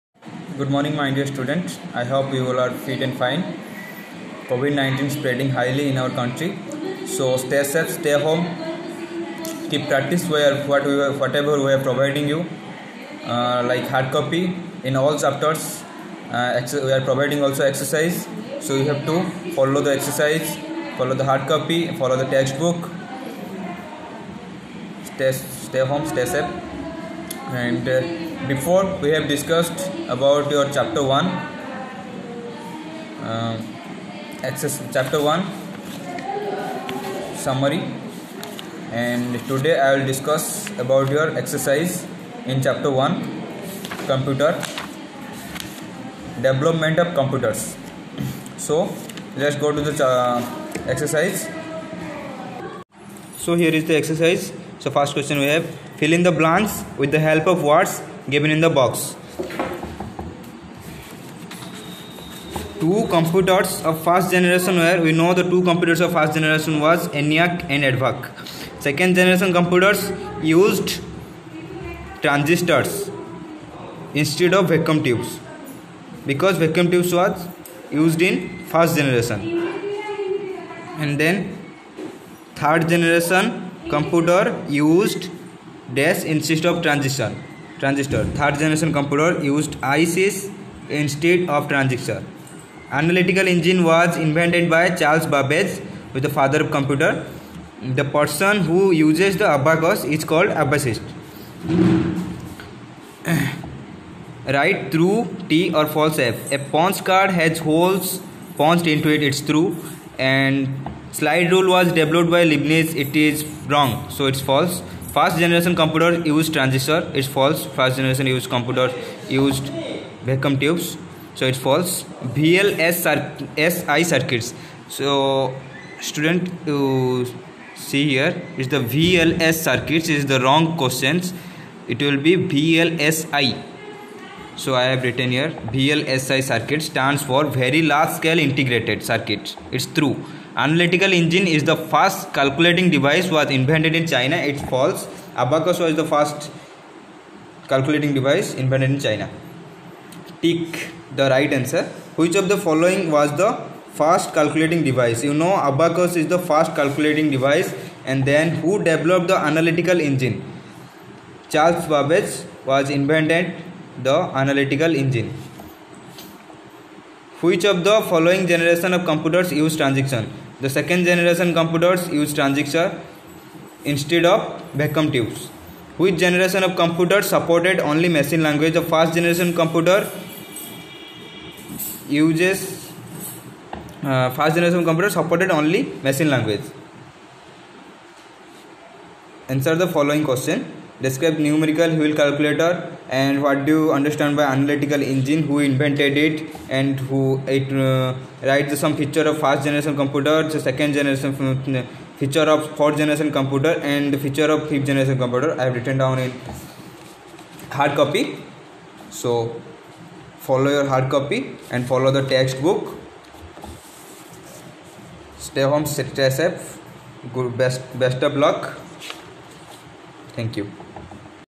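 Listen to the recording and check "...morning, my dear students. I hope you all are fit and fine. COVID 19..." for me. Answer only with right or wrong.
right.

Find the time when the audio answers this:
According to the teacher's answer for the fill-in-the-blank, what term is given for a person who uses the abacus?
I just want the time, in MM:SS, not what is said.
01:40.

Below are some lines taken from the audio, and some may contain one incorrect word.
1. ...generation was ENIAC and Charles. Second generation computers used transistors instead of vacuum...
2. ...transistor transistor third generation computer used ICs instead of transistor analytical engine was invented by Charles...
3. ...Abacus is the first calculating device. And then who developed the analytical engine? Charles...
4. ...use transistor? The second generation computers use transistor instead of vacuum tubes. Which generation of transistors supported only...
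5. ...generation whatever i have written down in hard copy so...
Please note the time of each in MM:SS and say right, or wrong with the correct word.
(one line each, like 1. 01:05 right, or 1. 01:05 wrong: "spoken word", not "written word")
1. 01:06 wrong: "EDVAC", not "Charles"
2. 01:26 right
3. 02:35 right
4. 02:49 wrong: "computers", not "transistors"
5. 03:24 wrong: "computer", not "whatever".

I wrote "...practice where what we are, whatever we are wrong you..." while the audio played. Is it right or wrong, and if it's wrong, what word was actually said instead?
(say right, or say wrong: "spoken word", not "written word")
wrong: "providing", not "wrong".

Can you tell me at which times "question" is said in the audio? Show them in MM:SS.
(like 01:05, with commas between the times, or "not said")
00:55, 02:10, 03:10.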